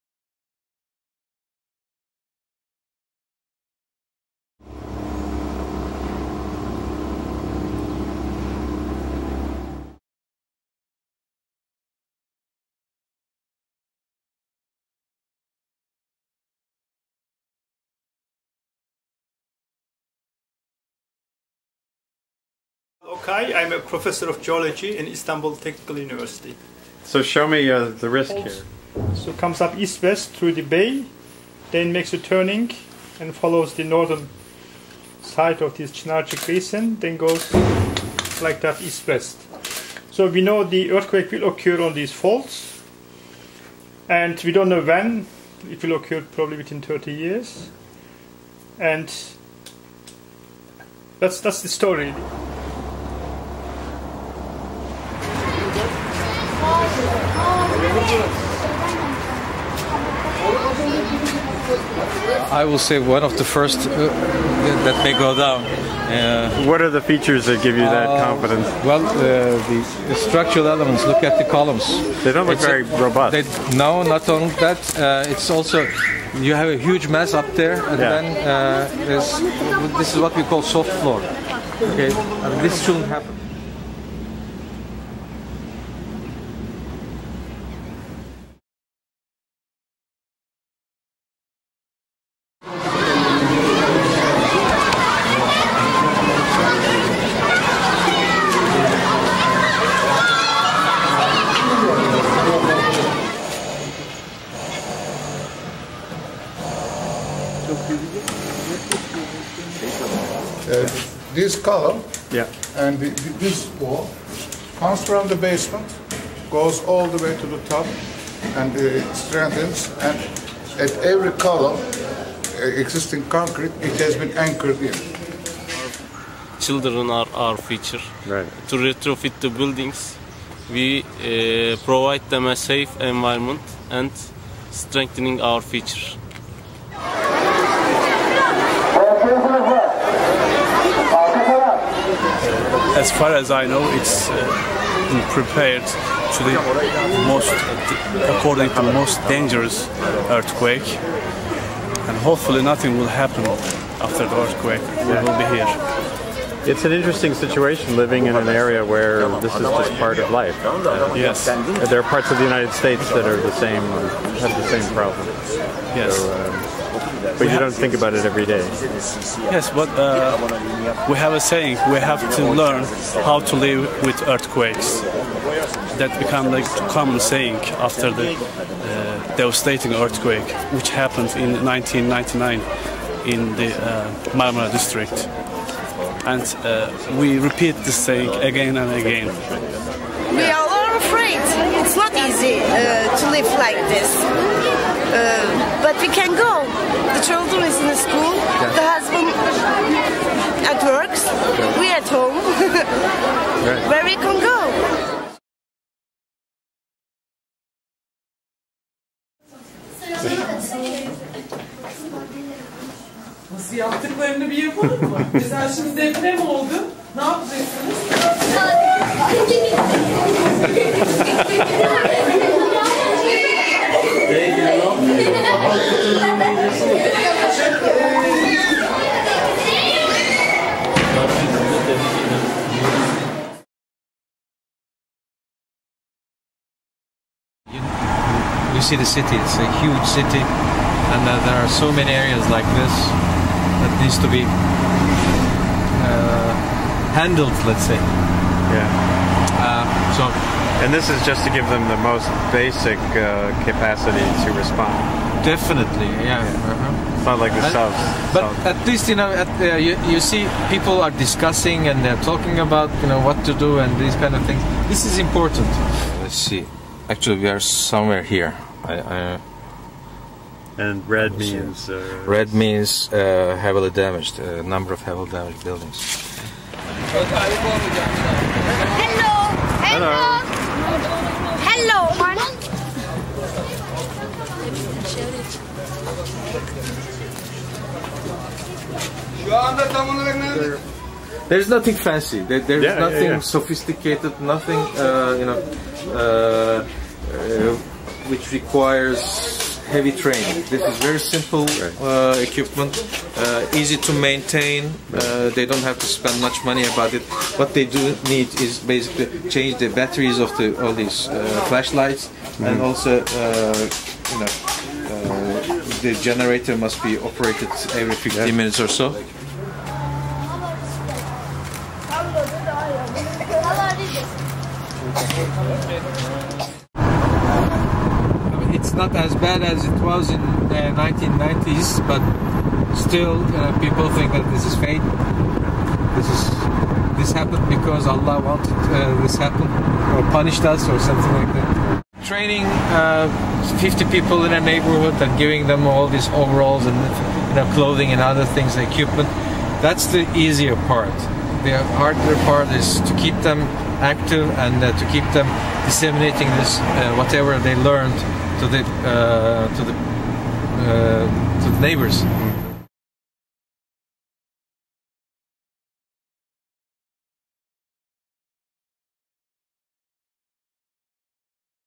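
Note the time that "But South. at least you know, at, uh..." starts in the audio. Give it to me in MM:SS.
04:18.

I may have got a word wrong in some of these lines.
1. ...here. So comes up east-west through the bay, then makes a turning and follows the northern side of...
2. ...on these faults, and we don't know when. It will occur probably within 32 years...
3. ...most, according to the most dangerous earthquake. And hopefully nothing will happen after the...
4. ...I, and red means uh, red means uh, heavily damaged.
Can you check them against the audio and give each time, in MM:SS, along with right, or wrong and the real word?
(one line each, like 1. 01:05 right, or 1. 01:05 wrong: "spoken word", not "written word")
1. 00:28 right
2. 00:41 wrong: "30", not "32"
3. 02:27 right
4. 04:28 right.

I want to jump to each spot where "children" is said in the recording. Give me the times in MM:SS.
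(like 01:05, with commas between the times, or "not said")
02:06, 03:17.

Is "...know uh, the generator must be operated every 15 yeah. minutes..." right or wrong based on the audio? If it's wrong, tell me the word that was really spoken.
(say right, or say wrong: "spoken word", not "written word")
right.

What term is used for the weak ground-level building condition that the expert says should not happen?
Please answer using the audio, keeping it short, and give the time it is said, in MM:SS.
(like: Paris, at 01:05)
soft floor, at 01:20.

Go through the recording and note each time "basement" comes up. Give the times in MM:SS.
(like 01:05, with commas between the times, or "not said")
01:55.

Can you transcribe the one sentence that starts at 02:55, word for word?
That become like common saying after the uh, devastating earthquake which happened in 1999 in the uh, Marmara district.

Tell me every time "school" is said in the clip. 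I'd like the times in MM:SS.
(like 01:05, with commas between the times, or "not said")
03:17.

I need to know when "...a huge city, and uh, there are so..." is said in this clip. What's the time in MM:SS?
03:59.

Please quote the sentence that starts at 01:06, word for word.
Uh, what are the features that give you that uh, confidence?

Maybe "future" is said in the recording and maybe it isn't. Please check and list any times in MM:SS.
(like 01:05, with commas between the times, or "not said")
02:07, 02:15.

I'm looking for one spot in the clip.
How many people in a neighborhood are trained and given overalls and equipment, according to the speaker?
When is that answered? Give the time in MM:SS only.
05:43.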